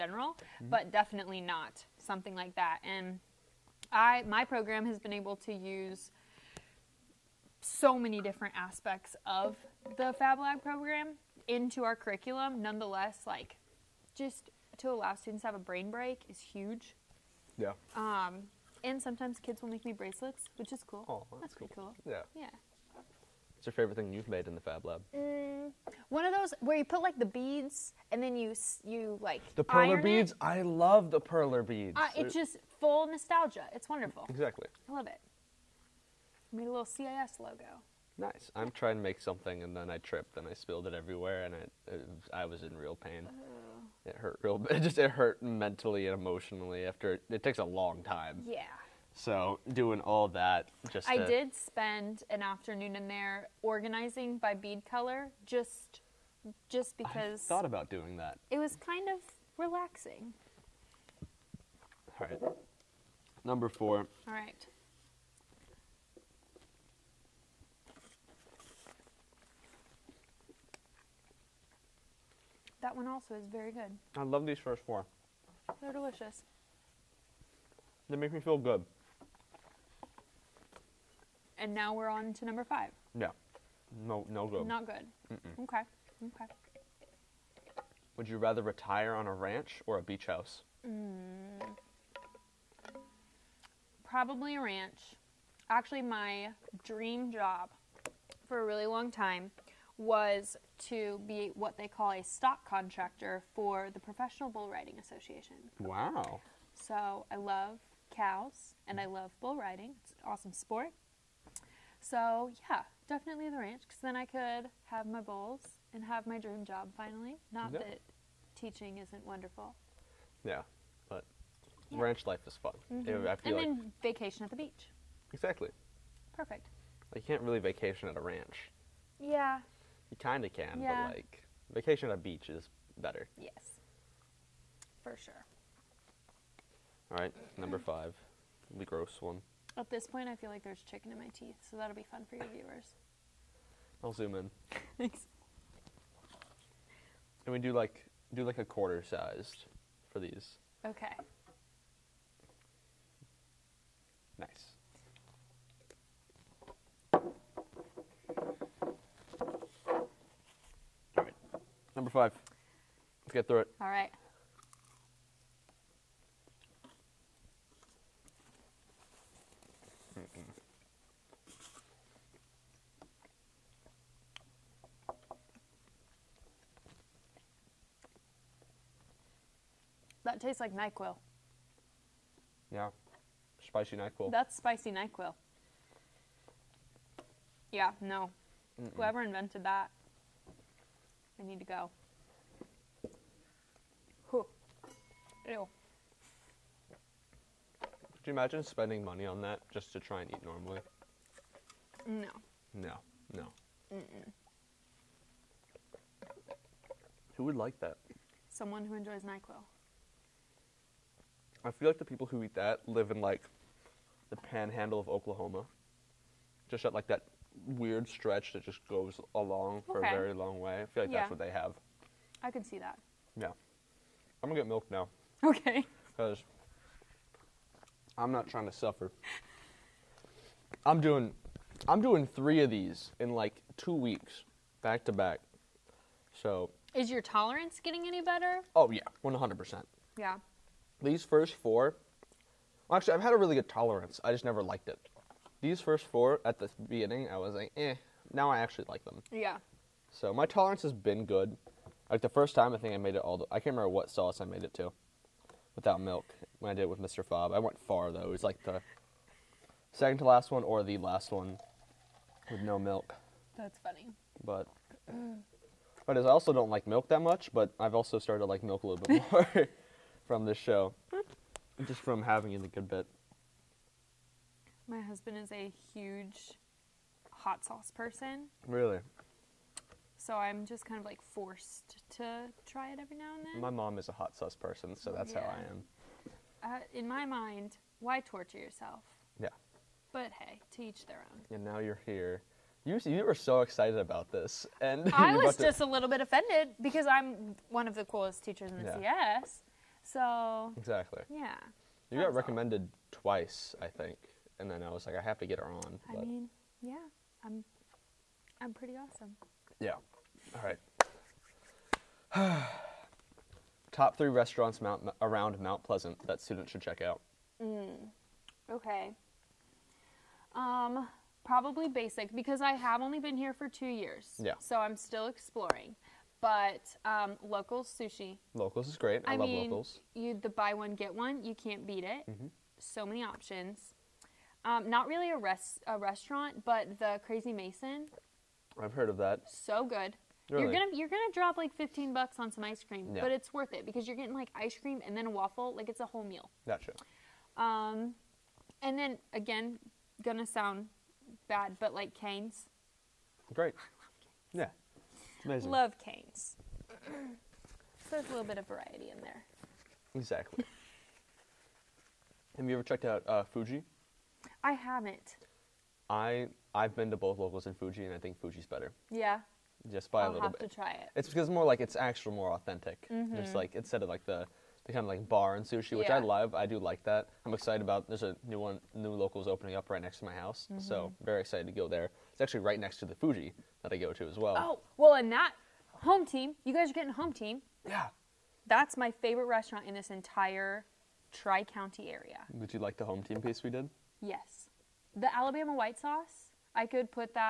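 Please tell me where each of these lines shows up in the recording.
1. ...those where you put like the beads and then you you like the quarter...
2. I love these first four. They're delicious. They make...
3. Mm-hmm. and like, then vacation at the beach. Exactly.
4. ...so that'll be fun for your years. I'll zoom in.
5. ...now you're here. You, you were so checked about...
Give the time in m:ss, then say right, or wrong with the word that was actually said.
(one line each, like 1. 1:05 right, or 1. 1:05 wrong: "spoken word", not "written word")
1. 0:26 wrong: "perler", not "quarter"
2. 1:14 right
3. 2:02 right
4. 2:21 wrong: "viewers", not "years"
5. 4:51 wrong: "excited", not "checked".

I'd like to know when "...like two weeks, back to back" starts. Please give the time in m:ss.
3:53.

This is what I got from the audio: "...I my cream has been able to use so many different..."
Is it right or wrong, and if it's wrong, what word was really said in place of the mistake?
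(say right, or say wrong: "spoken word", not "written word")
wrong: "program", not "cream".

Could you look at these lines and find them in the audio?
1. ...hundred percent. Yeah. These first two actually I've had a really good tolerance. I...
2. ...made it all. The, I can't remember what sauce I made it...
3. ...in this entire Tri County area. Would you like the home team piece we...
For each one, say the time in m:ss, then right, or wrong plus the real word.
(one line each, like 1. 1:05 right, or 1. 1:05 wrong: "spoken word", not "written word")
1. 3:59 wrong: "four", not "two"
2. 4:12 right
3. 6:29 right.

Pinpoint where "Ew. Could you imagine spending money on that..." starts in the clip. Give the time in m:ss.
3:15.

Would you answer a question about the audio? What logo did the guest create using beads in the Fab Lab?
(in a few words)
CAS logo.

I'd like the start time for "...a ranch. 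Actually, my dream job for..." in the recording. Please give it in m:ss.
1:34.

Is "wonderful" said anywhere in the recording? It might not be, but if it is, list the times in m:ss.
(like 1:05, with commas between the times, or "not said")
0:33, 1:59.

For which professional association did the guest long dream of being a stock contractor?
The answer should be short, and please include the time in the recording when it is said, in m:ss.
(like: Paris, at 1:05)
Professional Bull Riding Association, at 1:43.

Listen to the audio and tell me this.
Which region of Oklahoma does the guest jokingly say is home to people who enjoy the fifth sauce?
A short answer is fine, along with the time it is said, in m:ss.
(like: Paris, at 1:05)
the panhandle, at 3:34.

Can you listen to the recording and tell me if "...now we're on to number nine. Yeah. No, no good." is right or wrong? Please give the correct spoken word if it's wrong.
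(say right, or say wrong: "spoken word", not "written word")
wrong: "five", not "nine".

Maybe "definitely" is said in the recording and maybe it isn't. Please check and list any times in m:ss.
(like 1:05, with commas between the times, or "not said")
0:00, 1:53.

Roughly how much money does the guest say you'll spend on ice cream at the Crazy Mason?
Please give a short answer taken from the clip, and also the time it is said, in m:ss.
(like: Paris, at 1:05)
$15, at 5:41.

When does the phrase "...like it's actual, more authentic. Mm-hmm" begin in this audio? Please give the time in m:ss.
6:11.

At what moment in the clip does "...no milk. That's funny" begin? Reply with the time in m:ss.
4:22.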